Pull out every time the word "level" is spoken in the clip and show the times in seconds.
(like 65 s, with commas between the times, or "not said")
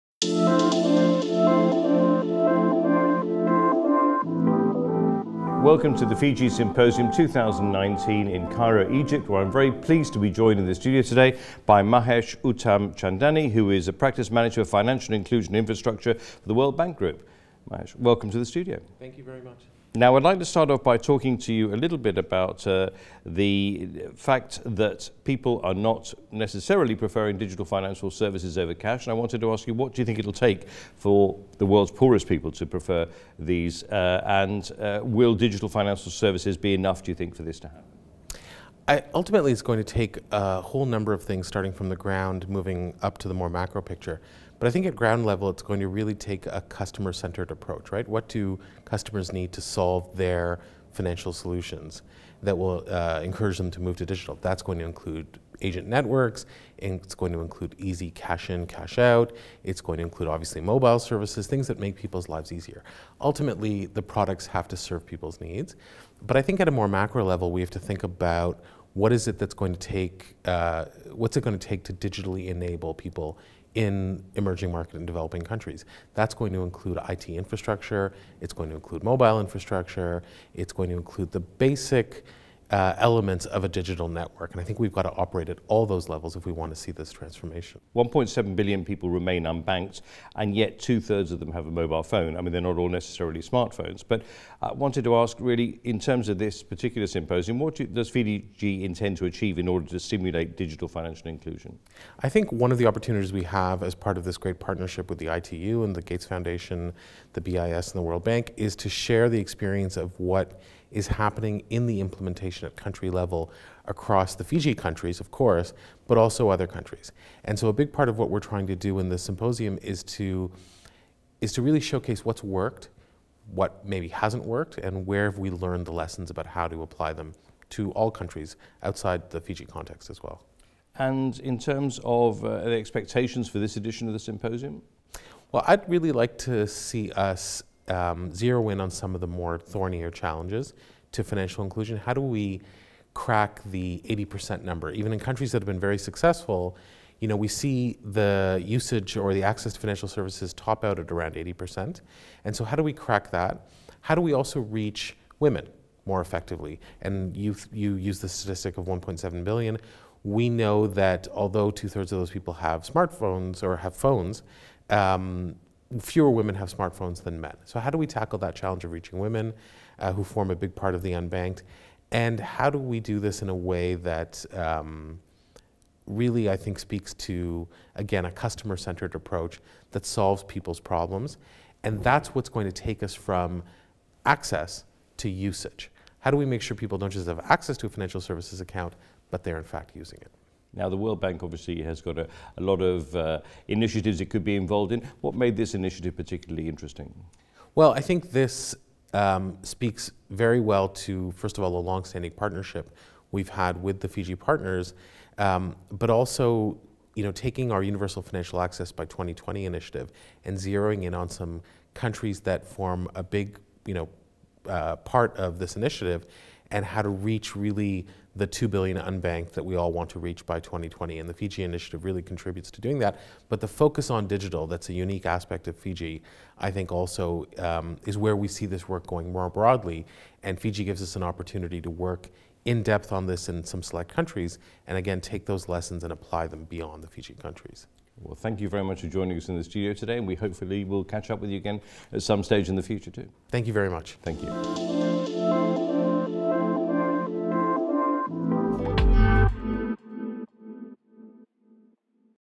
45 s, 67 s, 86 s, 113 s.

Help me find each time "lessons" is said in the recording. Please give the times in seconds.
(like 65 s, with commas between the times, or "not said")
125 s, 235 s.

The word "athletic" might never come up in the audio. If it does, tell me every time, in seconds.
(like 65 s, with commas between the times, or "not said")
not said.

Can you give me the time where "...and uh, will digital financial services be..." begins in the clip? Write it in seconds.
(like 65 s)
34 s.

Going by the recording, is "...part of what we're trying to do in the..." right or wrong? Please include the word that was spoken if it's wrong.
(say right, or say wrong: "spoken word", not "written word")
right.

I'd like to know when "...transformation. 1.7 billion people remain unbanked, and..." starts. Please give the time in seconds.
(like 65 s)
87 s.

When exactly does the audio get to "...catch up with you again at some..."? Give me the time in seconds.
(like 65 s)
241 s.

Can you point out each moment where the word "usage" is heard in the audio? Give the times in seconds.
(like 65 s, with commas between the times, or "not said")
148 s, 185 s.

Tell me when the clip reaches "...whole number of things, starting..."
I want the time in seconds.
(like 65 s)
40 s.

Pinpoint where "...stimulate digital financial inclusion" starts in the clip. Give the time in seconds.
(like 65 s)
99 s.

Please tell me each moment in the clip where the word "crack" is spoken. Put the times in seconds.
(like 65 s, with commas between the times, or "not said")
143 s, 152 s.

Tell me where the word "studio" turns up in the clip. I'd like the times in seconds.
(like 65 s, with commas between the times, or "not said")
10 s, 18 s, 239 s.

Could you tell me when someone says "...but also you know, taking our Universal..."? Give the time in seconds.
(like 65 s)
205 s.